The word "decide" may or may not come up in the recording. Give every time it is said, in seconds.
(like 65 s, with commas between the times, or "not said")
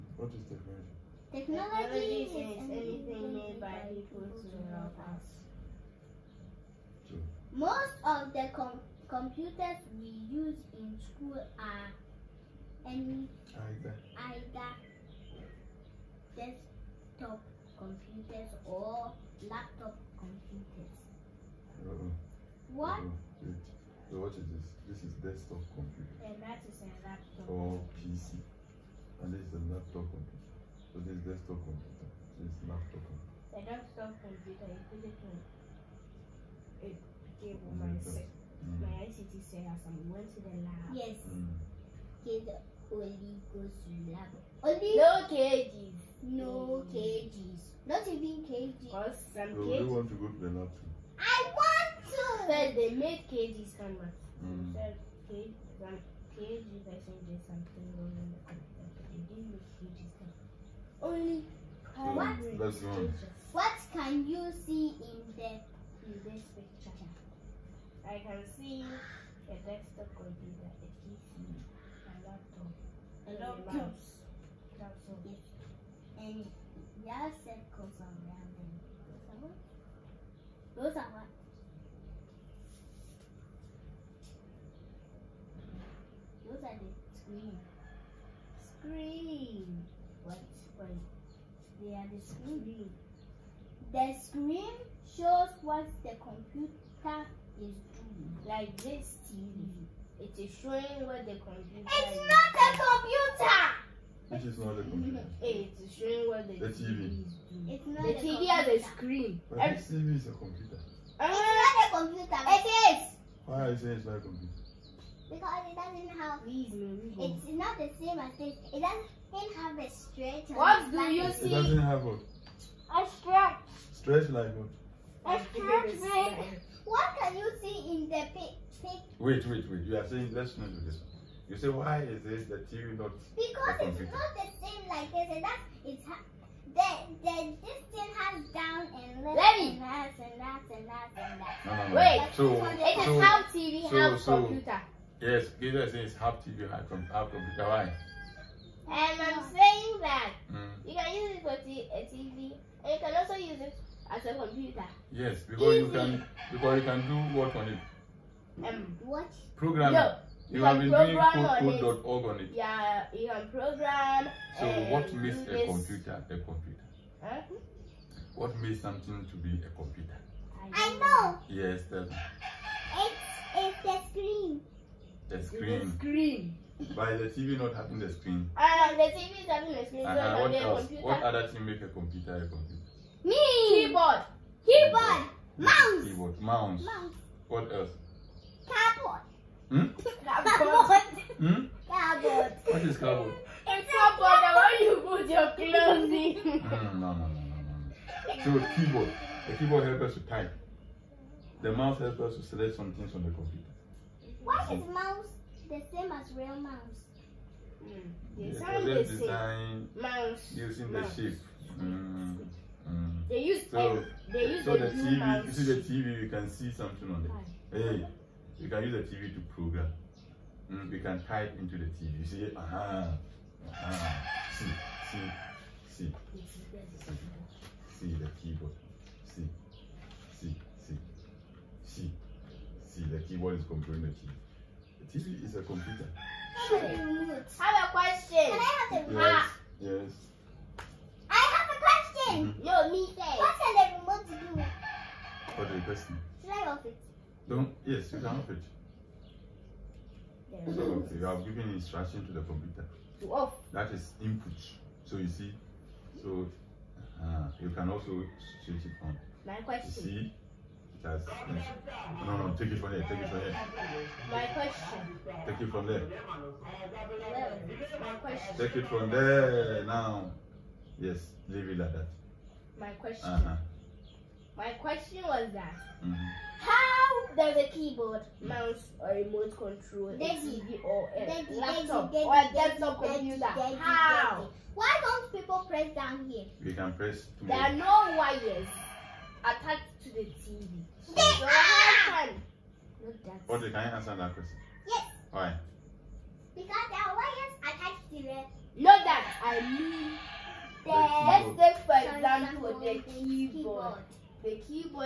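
not said.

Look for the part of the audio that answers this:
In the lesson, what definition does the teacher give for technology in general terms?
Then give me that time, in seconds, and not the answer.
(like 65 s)
2 s.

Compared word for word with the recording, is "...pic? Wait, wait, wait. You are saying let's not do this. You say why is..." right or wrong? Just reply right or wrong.
right.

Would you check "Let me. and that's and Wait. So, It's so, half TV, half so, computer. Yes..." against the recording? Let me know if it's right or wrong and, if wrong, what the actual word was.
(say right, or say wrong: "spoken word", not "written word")
right.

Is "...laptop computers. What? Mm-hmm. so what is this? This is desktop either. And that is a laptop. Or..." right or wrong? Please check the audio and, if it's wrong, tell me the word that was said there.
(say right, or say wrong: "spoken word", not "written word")
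wrong: "computer", not "either".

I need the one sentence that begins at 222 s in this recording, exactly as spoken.
You see, aha, uh -huh, uh -huh.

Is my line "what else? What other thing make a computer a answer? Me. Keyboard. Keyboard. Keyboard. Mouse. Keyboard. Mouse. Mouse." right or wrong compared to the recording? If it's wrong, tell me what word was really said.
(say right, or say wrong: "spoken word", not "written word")
wrong: "computer", not "answer".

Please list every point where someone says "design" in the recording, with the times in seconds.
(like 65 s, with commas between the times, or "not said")
209 s.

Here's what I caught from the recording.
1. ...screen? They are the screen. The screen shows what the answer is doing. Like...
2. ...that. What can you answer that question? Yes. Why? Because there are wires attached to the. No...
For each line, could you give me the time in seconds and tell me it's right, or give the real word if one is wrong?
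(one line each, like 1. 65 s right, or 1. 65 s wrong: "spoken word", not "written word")
1. 90 s wrong: "computer", not "answer"
2. 293 s right.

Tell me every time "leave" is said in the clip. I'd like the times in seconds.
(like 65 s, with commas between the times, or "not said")
271 s.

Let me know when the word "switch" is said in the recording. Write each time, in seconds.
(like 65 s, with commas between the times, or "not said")
258 s.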